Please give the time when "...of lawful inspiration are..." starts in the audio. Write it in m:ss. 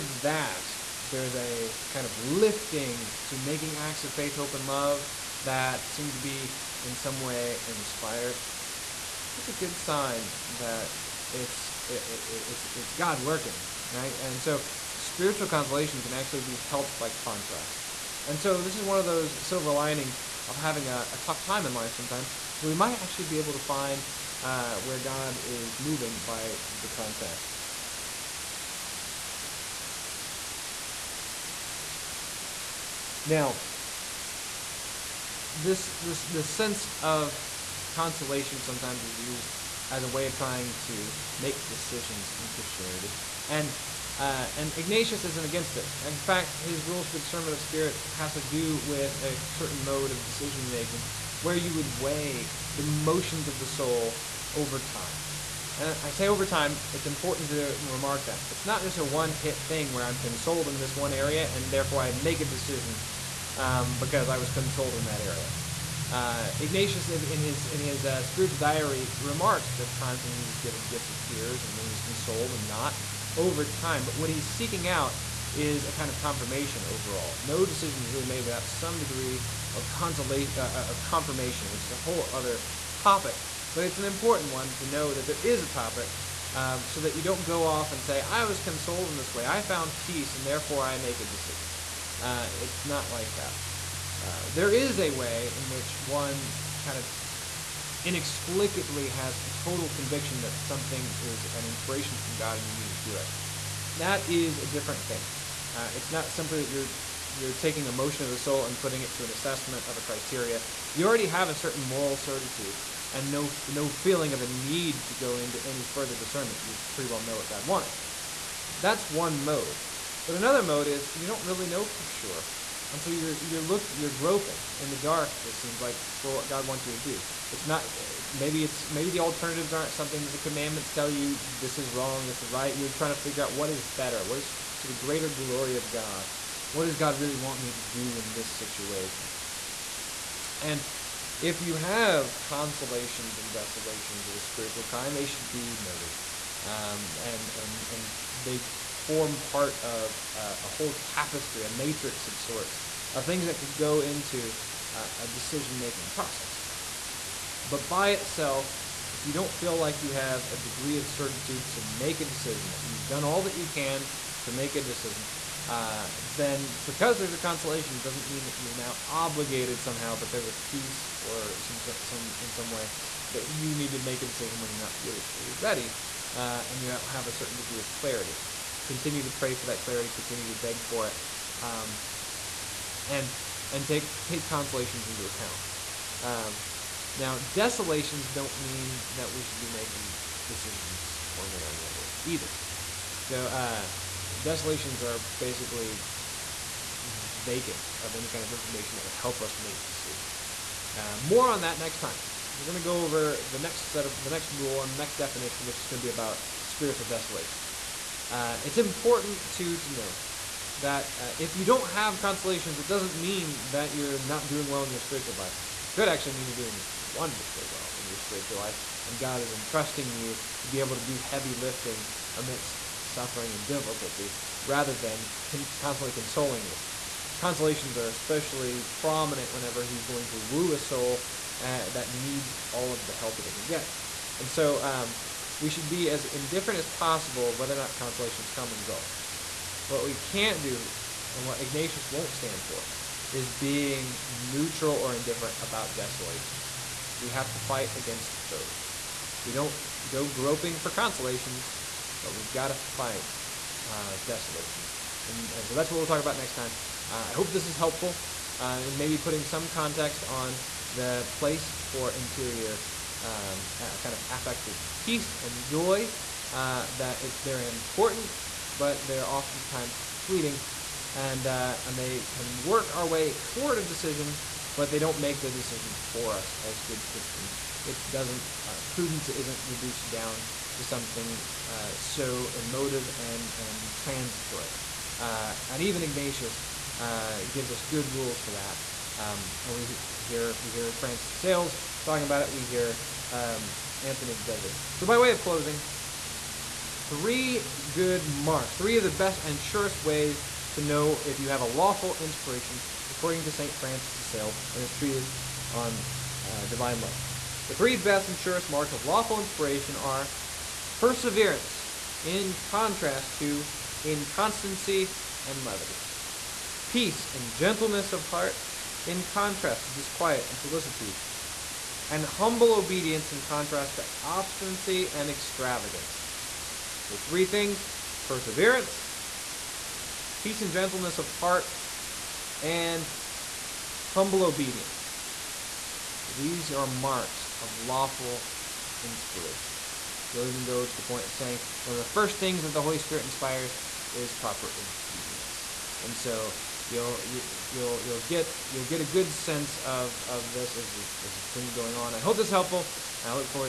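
5:08.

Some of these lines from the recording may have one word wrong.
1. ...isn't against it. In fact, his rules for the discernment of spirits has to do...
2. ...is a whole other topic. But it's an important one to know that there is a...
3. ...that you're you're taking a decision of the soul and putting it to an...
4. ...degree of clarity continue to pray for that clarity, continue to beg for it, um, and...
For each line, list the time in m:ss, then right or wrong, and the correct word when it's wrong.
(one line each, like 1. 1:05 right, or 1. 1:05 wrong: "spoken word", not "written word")
1. 0:45 right
2. 1:21 right
3. 1:46 wrong: "motion", not "decision"
4. 2:57 right.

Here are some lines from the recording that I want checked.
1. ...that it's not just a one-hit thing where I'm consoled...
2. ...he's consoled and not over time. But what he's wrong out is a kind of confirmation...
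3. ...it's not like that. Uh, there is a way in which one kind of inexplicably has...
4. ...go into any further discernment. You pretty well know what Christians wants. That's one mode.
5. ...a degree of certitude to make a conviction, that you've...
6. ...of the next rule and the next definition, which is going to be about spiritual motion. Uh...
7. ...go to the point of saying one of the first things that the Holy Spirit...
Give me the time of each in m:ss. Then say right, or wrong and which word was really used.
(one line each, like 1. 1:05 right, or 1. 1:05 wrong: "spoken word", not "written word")
1. 0:58 right
2. 1:11 wrong: "seeking", not "wrong"
3. 1:32 right
4. 1:55 wrong: "God", not "Christians"
5. 2:40 wrong: "decision", not "conviction"
6. 3:24 wrong: "desolation", not "motion"
7. 5:40 right.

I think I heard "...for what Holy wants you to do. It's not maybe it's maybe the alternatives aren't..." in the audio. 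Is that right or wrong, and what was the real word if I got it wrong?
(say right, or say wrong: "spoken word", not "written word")
wrong: "God", not "Holy".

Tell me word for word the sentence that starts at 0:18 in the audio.
And so this is one of those silver linings of having a, a tough time in life sometimes.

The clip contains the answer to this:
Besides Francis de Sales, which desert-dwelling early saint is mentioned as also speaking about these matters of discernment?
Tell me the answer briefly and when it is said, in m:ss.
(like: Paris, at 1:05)
Anthony of the Desert, at 4:54.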